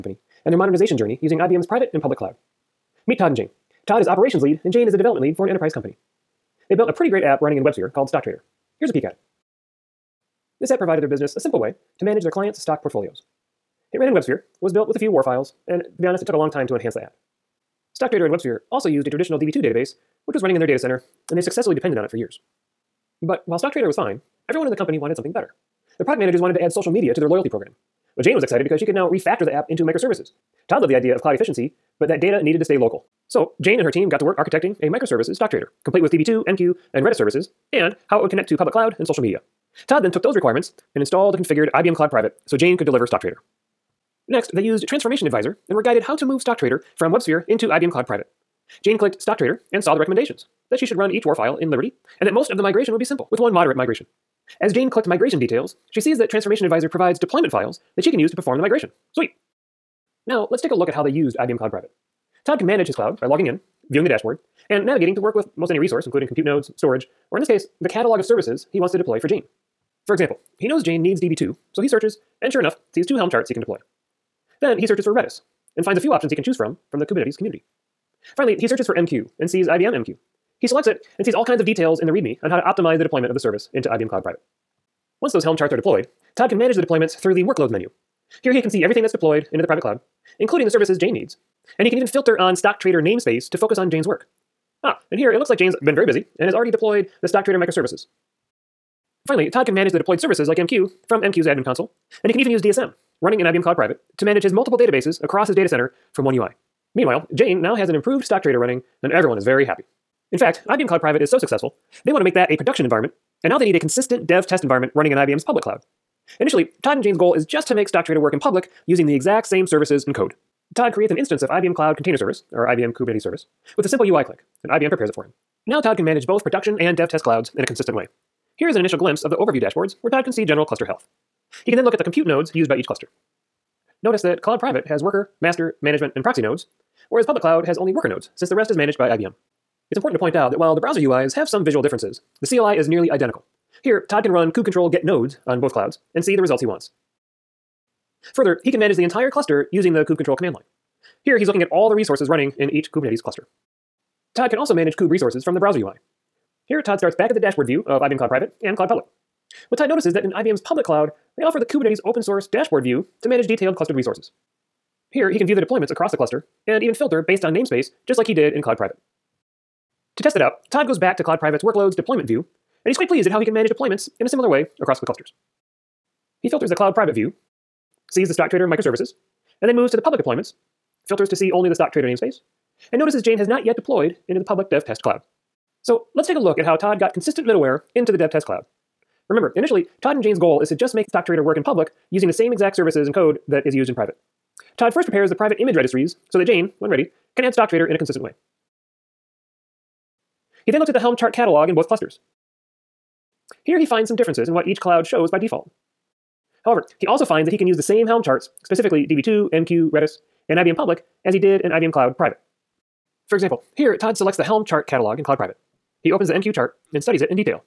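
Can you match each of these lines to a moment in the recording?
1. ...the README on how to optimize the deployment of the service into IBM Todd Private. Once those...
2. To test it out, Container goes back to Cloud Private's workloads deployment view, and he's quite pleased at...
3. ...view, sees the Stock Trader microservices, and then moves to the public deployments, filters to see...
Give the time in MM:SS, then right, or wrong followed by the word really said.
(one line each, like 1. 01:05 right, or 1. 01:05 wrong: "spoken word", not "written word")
1. 01:22 wrong: "Cloud", not "Todd"
2. 02:50 wrong: "Todd", not "Container"
3. 02:57 right.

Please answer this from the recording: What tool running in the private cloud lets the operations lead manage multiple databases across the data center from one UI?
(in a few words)
DSM.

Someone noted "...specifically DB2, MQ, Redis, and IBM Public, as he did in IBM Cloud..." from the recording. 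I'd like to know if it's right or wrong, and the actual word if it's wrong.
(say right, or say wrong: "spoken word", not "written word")
right.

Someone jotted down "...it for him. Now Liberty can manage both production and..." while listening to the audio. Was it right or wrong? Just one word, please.
wrong.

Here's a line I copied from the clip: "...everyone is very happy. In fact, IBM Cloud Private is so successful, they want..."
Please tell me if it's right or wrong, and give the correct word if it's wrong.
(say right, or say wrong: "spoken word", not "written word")
right.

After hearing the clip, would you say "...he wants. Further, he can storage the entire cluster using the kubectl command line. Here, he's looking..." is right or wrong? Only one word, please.
wrong.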